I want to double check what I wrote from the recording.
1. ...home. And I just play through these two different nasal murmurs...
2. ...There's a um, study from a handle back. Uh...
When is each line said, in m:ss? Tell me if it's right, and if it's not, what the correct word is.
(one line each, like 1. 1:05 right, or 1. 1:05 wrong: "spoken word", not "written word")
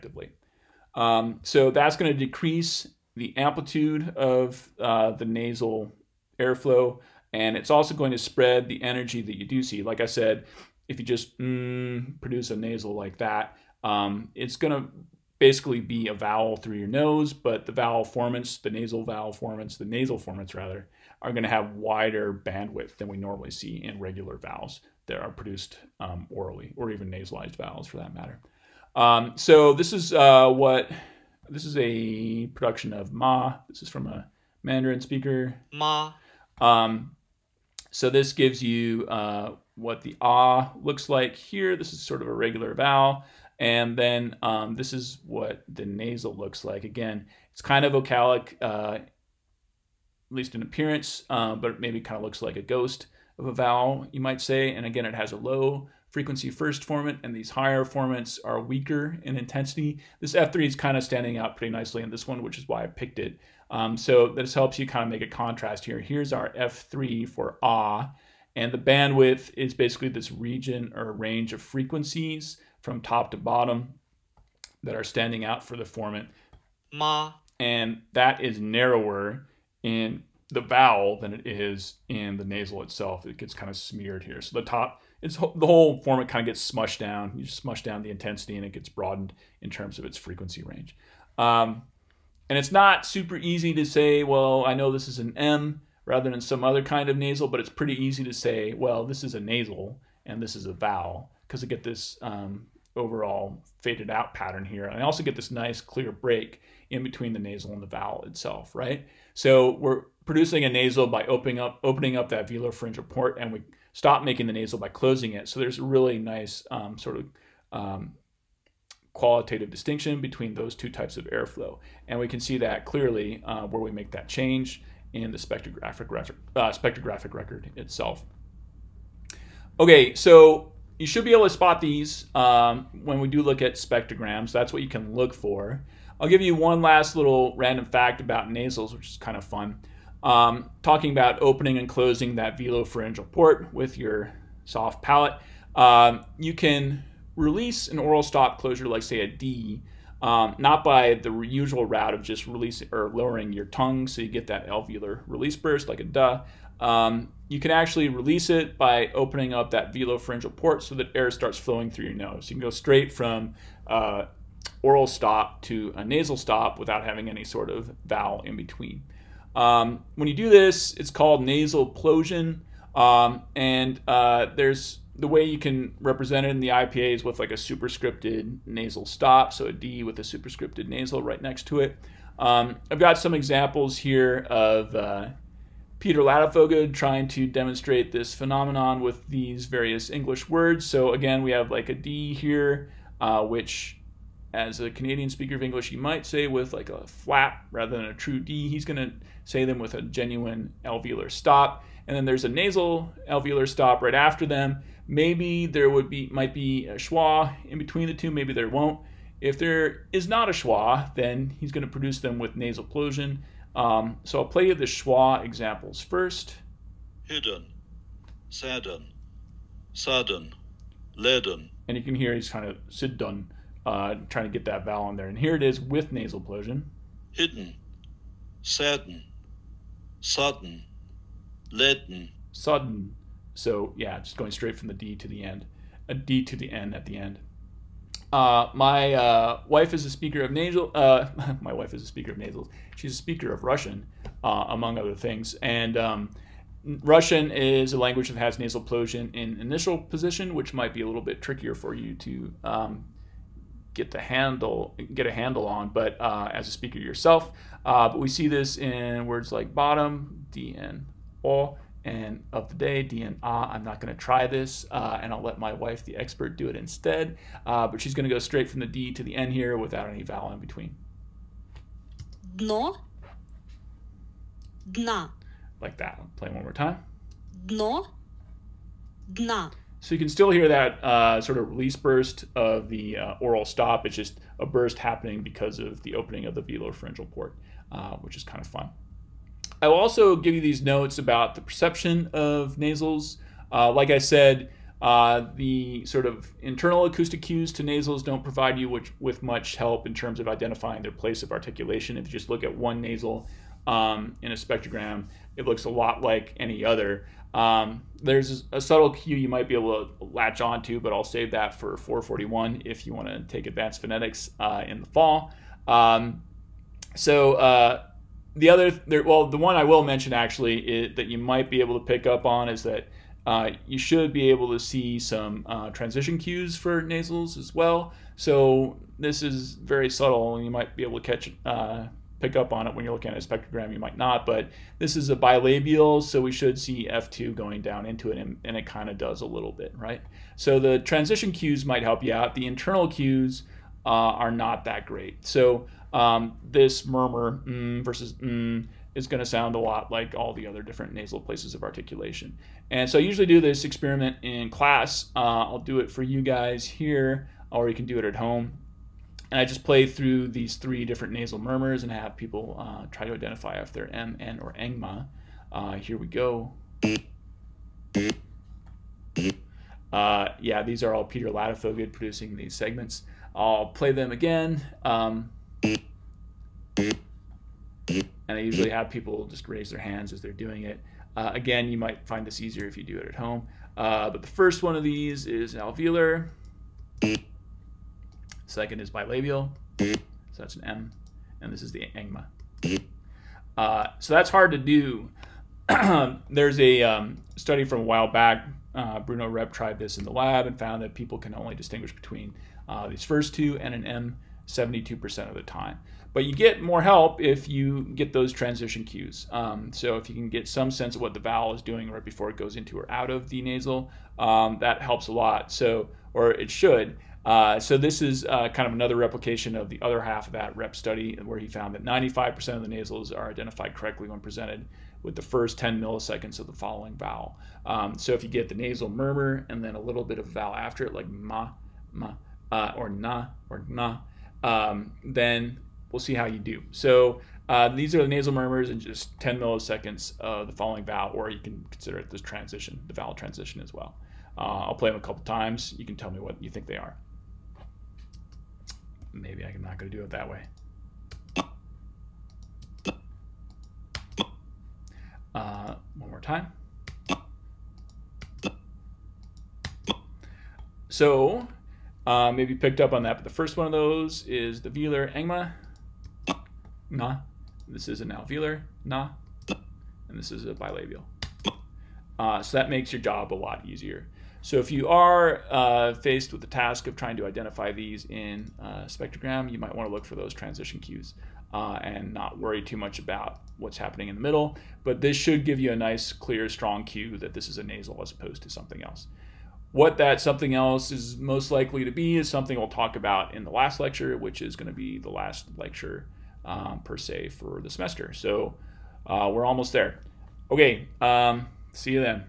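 1. 5:58 wrong: "three", not "two"
2. 6:36 wrong: "while", not "handle".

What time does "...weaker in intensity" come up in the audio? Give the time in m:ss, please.
0:58.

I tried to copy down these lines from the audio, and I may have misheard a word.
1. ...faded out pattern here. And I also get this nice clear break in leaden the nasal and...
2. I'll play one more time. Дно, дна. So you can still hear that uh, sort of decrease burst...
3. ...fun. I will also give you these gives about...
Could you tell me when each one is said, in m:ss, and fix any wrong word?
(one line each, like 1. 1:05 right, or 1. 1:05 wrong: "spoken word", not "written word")
1. 1:43 wrong: "between", not "leaden"
2. 4:36 wrong: "release", not "decrease"
3. 4:48 wrong: "notes", not "gives".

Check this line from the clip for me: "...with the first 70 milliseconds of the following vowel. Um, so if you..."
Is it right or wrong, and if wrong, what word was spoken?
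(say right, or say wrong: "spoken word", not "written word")
wrong: "10", not "70".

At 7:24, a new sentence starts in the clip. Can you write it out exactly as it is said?
Uh, I'll play them a couple times.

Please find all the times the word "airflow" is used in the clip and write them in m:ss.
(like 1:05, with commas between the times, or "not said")
0:06, 2:01.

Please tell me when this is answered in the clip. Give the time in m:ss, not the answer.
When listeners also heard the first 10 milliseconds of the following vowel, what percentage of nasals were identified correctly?
7:02.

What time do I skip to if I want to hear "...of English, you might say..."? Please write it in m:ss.
3:15.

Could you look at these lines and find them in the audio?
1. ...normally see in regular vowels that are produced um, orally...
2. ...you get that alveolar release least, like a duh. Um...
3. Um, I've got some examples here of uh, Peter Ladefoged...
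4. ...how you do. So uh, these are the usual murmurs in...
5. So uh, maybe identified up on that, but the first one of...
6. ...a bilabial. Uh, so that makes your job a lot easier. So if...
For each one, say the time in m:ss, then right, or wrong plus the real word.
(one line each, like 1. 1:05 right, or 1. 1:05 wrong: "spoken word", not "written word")
1. 0:23 right
2. 2:34 wrong: "burst", not "least"
3. 3:02 right
4. 7:16 wrong: "nasal", not "usual"
5. 7:41 wrong: "picked", not "identified"
6. 7:50 right.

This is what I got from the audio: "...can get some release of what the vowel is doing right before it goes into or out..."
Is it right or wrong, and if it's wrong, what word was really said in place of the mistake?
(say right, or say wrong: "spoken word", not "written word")
wrong: "sense", not "release".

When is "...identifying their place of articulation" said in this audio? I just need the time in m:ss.
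5:00.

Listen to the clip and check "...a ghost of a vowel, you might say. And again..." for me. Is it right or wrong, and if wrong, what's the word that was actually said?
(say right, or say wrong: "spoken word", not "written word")
right.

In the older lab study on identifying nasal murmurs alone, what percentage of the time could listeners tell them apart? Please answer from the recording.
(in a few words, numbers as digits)
72%.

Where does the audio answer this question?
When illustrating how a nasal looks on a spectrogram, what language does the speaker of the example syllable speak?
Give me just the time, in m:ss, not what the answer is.
0:34.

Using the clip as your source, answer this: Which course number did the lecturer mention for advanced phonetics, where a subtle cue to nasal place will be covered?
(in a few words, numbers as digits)
441.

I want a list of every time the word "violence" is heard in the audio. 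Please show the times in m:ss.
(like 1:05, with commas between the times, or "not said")
not said.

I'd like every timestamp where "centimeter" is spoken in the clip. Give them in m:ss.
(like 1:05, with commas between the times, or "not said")
not said.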